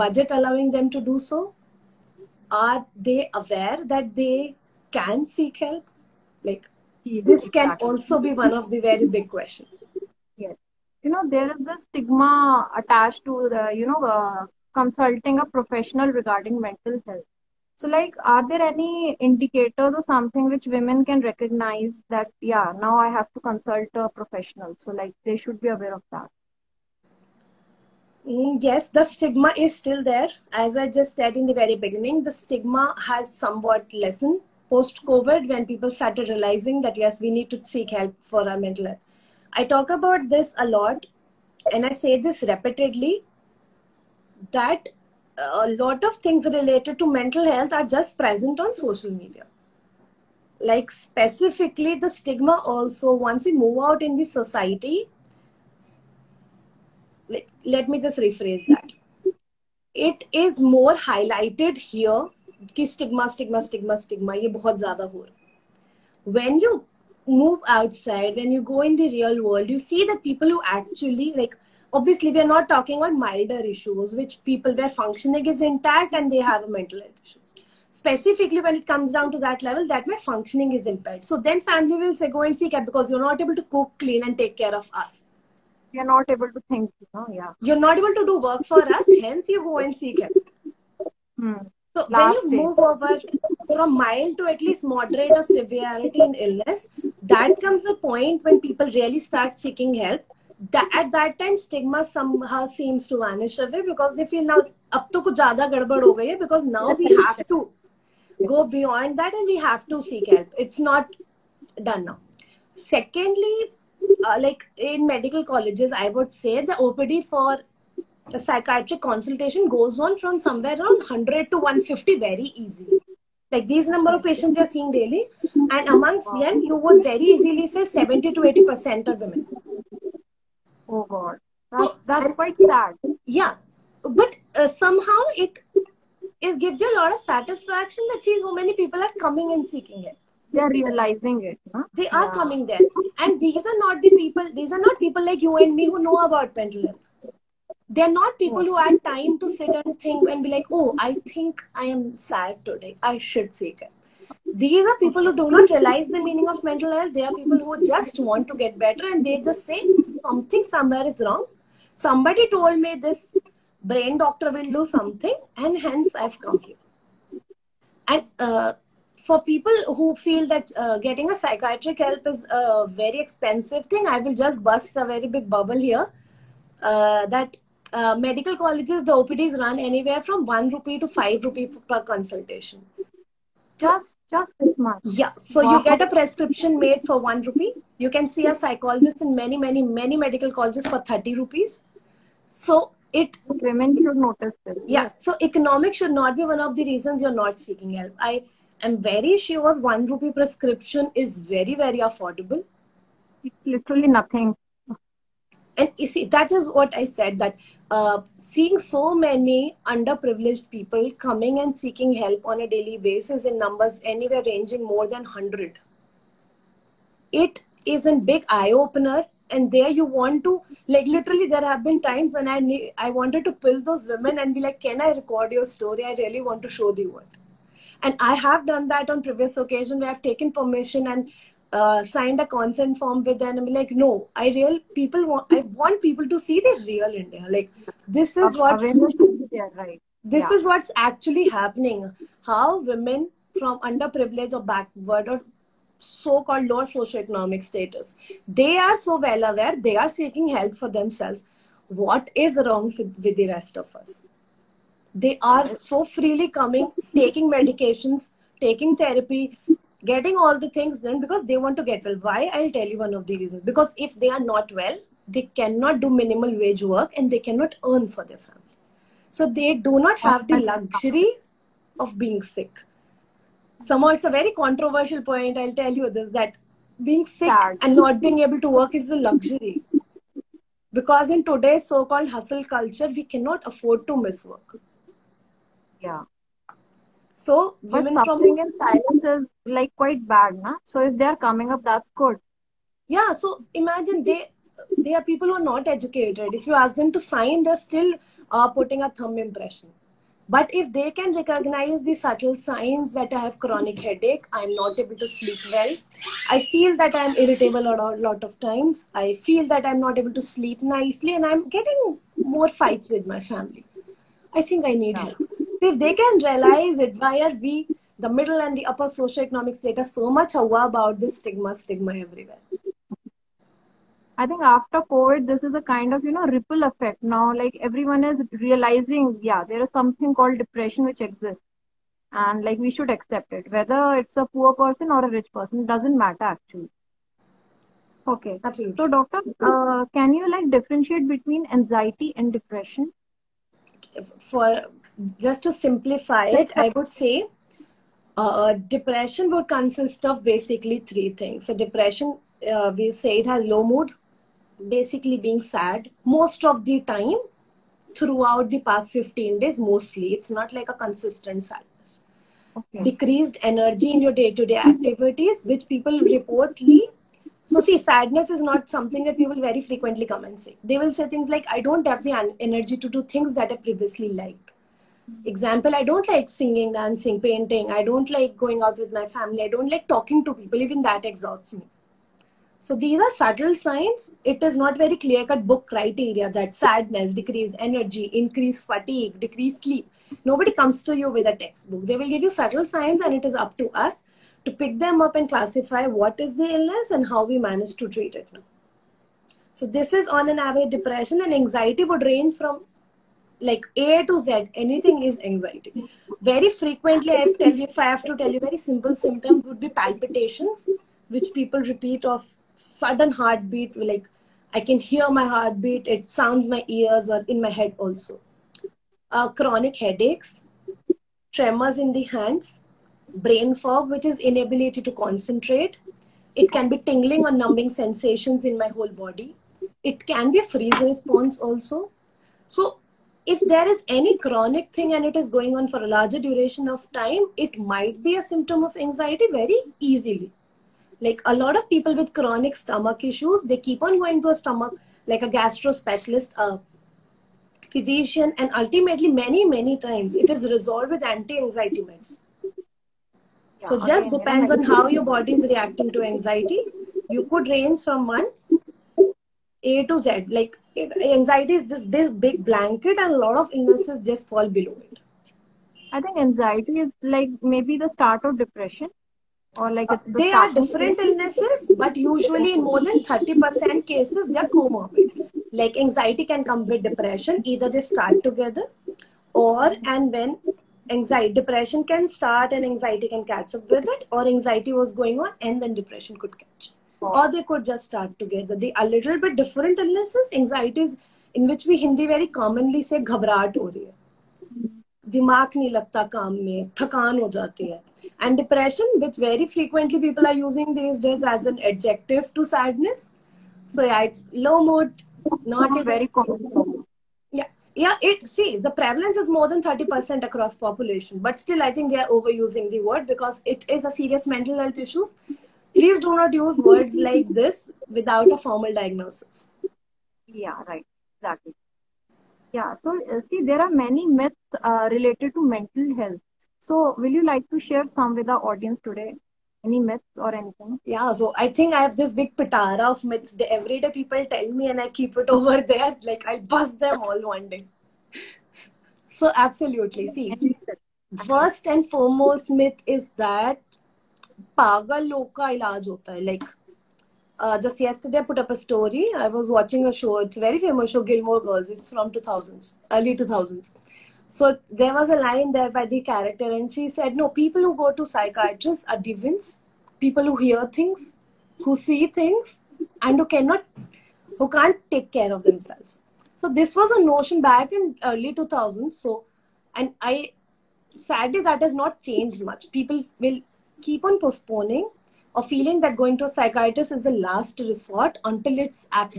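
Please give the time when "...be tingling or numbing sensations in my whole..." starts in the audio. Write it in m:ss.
7:06.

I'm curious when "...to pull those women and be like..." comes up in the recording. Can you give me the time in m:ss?
3:43.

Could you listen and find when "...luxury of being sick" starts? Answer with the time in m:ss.
4:30.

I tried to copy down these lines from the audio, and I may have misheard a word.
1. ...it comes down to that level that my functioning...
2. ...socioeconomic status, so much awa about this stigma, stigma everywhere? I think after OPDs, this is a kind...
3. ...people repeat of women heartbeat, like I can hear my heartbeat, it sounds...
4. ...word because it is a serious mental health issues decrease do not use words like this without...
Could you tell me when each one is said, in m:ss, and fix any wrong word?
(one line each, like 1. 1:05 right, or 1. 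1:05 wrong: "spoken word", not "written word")
1. 1:18 right
2. 5:19 wrong: "COVID", not "OPDs"
3. 6:51 wrong: "sudden", not "women"
4. 8:33 wrong: "please", not "decrease".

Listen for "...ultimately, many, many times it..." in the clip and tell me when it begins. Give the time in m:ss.
7:28.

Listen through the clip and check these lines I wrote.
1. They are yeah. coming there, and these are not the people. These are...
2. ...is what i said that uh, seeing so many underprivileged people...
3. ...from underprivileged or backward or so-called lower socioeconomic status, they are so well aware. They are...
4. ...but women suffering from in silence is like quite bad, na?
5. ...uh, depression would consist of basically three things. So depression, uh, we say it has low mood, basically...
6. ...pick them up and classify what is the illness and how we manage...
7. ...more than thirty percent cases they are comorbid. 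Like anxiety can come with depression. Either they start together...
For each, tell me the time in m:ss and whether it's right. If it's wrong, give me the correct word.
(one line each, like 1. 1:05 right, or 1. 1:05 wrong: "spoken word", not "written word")
1. 2:22 right
2. 3:26 right
3. 4:03 right
4. 4:47 right
5. 5:48 right
6. 6:34 right
7. 7:52 right.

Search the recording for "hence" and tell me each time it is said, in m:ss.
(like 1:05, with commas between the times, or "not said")
1:29, 2:45.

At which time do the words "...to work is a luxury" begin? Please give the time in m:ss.
4:38.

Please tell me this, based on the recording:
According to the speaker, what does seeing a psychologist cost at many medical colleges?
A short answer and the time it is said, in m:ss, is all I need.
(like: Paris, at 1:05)
30 rupees, at 3:11.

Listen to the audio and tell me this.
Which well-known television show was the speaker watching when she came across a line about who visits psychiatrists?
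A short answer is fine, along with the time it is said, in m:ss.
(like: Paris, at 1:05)
Gilmore Girls, at 9:11.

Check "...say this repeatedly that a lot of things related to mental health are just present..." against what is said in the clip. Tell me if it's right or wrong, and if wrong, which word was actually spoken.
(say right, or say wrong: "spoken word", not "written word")
right.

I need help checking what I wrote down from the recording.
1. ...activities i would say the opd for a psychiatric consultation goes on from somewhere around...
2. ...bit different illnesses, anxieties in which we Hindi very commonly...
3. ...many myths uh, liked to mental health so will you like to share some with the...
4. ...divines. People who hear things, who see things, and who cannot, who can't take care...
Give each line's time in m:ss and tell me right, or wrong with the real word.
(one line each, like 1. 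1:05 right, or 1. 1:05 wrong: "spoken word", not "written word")
1. 1:55 wrong: "colleges", not "activities"
2. 8:09 right
3. 8:44 wrong: "related", not "liked"
4. 9:19 right.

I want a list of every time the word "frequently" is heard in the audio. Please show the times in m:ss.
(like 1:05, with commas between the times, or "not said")
6:09, 6:46.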